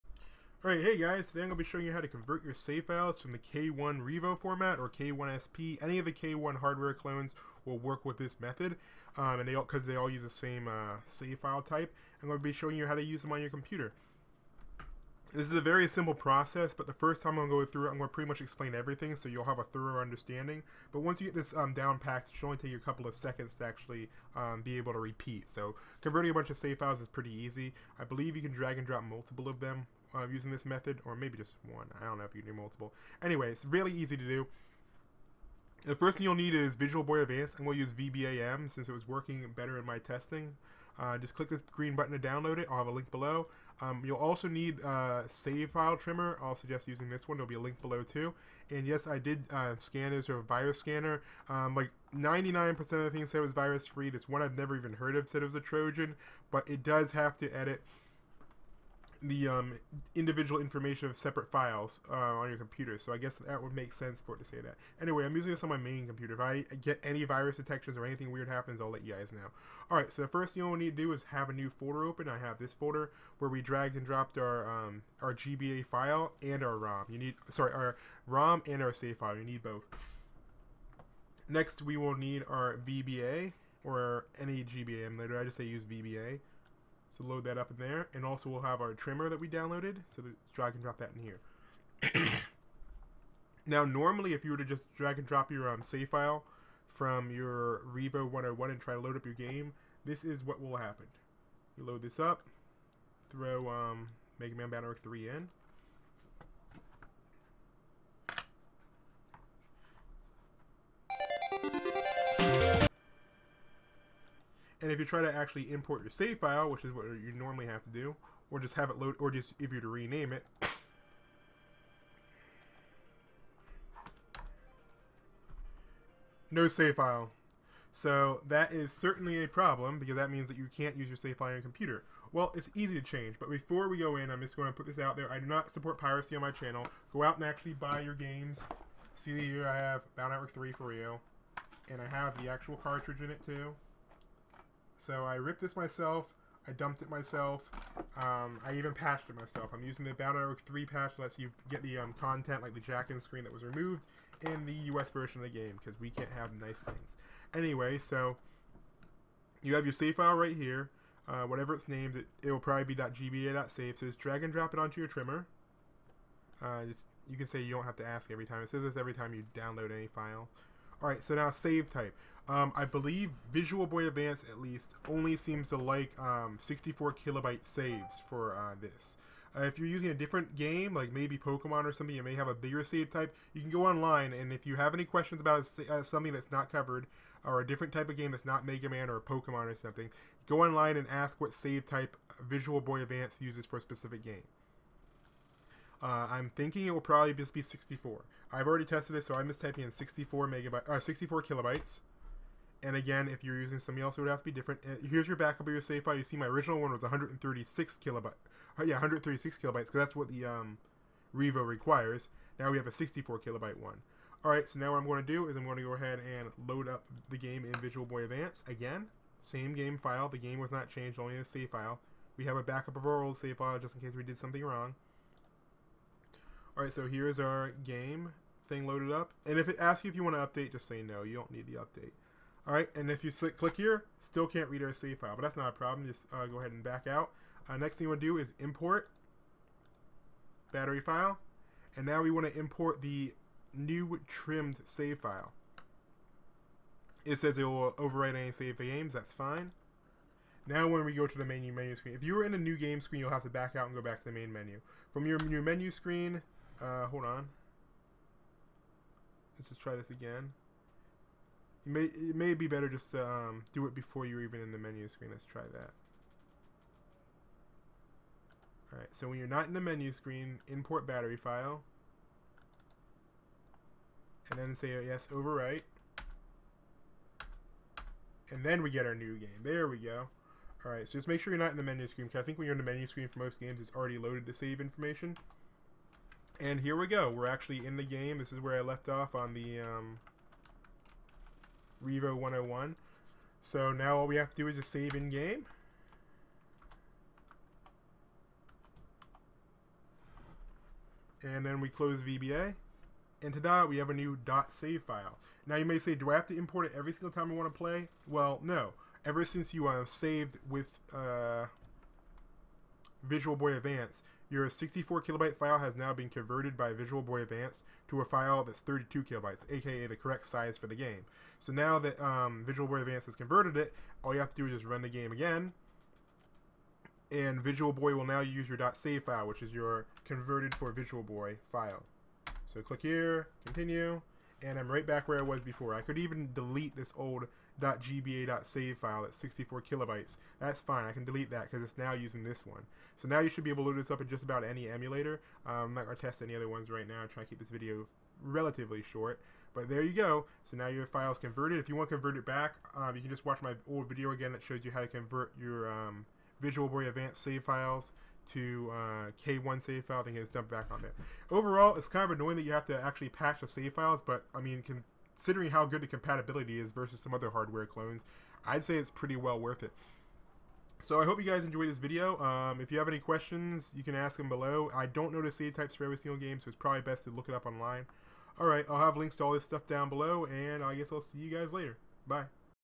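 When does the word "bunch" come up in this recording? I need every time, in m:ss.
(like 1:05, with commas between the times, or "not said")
0:26.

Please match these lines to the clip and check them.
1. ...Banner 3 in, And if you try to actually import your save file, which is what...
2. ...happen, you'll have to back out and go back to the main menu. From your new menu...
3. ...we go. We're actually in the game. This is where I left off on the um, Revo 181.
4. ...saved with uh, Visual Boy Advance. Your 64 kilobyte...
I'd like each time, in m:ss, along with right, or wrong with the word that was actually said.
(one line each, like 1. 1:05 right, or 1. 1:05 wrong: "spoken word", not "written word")
1. 1:44 right
2. 4:13 wrong: "screen", not "happen"
3. 4:46 wrong: "101", not "181"
4. 5:10 right.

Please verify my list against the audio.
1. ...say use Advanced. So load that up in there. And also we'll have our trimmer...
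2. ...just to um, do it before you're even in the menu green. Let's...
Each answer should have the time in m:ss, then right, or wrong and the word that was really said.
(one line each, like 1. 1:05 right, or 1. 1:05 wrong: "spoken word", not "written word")
1. 1:25 wrong: "VBA", not "Advanced"
2. 4:22 wrong: "screen", not "green".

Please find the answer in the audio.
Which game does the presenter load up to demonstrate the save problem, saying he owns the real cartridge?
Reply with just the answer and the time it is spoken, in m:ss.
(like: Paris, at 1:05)
Battle Network 3, at 2:20.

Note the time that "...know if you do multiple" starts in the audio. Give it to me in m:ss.
0:32.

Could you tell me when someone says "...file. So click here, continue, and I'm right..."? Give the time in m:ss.
5:31.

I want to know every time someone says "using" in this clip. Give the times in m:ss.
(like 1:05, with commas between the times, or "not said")
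0:30, 0:46, 1:05, 2:29, 2:59, 3:23, 5:42.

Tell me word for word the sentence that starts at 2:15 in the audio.
I do not support piracy on my channel.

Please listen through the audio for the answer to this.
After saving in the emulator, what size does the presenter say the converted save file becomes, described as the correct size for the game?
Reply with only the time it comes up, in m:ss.
5:18.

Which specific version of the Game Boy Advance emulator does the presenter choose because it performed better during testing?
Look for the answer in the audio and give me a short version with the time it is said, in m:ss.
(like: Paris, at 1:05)
VBAM, at 0:37.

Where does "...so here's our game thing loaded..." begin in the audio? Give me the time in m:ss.
3:46.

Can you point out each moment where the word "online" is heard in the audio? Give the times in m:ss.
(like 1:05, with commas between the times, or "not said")
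3:03, 3:10, 6:17.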